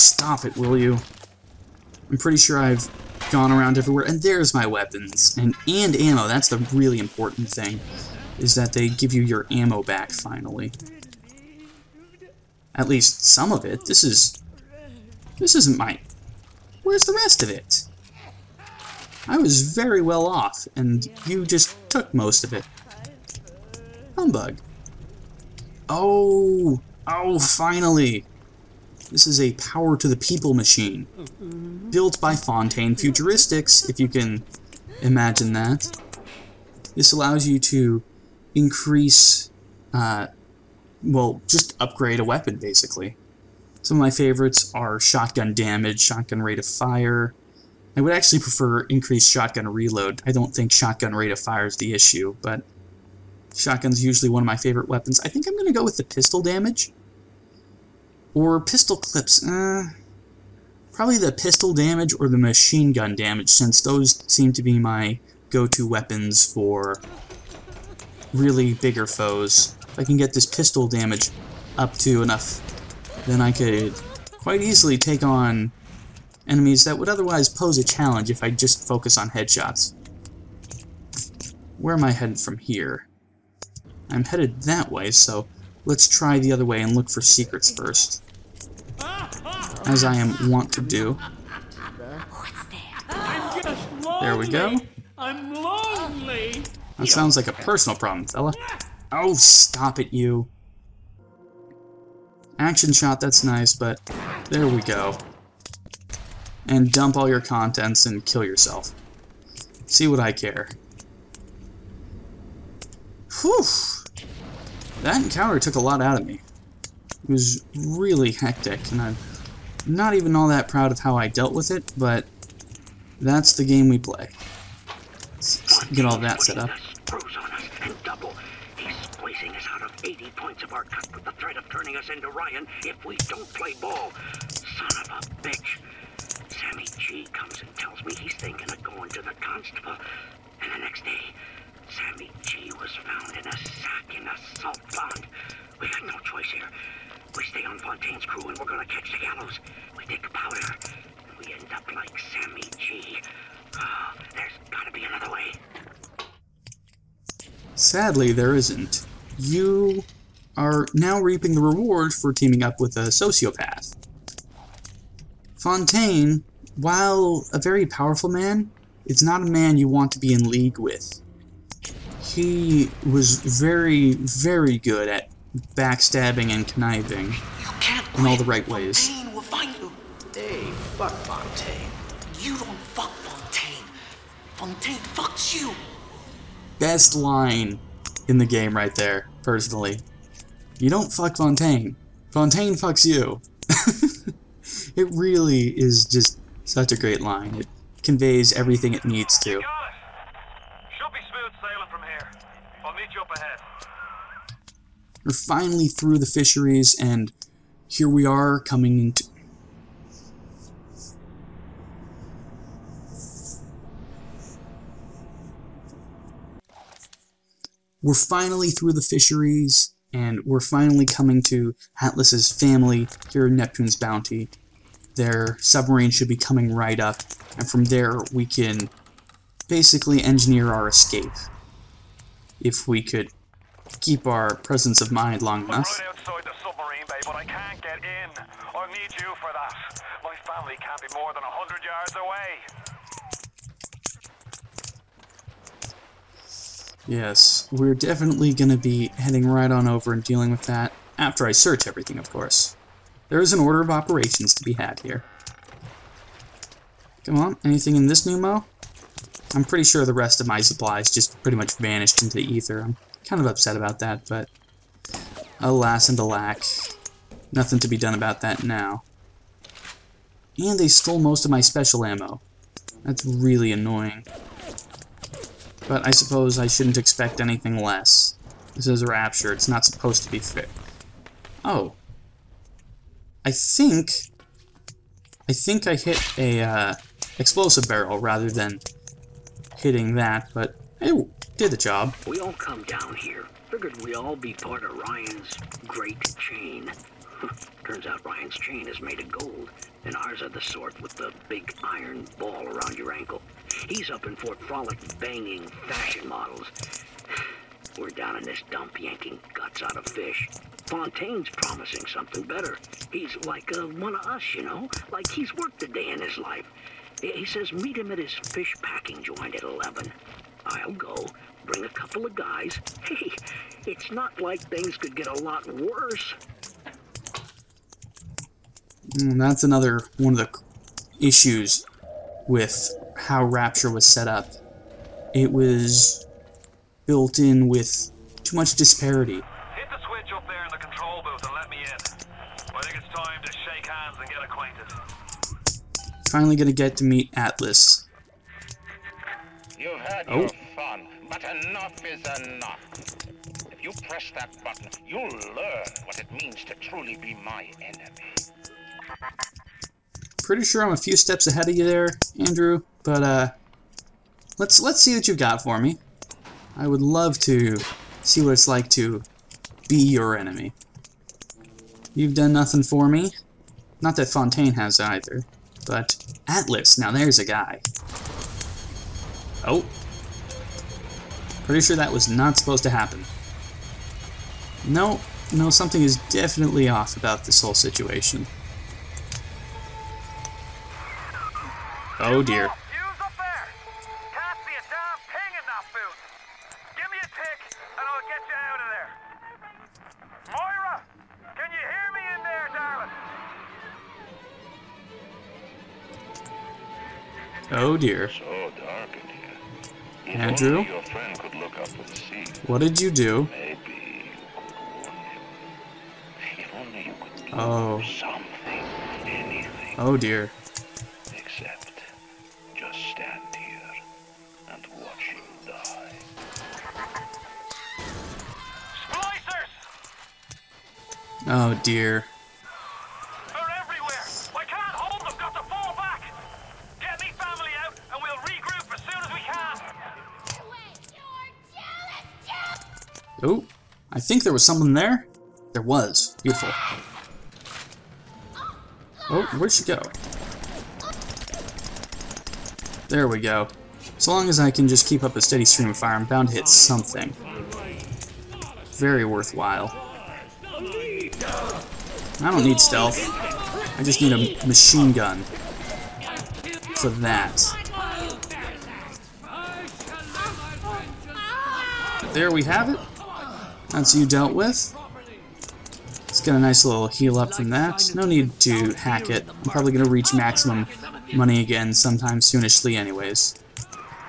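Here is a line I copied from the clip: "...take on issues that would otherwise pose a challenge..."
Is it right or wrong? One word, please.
wrong.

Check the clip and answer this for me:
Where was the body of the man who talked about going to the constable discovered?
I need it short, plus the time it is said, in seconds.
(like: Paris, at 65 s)
a salt pond, at 144 s.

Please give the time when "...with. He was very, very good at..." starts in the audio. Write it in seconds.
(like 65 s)
170 s.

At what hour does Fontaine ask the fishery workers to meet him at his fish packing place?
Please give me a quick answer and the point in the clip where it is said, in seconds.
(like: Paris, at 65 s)
11, at 319 s.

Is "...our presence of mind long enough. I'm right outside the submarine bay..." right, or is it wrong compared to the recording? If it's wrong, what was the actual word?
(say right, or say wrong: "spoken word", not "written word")
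right.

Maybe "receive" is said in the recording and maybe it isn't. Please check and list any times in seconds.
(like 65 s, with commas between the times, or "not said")
not said.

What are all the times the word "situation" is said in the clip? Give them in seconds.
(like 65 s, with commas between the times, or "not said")
387 s.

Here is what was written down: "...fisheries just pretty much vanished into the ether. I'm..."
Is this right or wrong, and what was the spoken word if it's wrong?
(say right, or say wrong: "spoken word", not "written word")
wrong: "supplies", not "fisheries".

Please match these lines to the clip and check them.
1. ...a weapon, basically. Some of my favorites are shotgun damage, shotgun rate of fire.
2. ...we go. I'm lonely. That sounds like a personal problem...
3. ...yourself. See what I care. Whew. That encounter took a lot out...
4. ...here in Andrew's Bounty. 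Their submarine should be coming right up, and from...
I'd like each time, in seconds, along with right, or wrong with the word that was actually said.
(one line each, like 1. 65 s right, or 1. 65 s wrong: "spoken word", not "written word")
1. 42 s right
2. 94 s right
3. 108 s right
4. 223 s wrong: "Neptune", not "Andrew".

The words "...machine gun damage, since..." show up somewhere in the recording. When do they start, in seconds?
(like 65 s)
62 s.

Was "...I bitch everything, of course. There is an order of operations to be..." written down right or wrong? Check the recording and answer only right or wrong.
wrong.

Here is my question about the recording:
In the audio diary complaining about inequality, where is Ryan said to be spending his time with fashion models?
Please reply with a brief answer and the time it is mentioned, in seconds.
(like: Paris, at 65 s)
Fort Frolic, at 304 s.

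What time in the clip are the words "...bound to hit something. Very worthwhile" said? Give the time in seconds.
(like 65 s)
456 s.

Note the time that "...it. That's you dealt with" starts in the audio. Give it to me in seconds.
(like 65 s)
472 s.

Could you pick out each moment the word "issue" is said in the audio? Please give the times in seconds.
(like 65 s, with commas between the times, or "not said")
51 s, 331 s.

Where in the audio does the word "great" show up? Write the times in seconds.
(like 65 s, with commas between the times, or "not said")
196 s, 295 s.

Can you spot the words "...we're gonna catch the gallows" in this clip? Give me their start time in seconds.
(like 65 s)
148 s.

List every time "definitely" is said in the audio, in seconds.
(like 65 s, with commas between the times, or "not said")
247 s, 386 s.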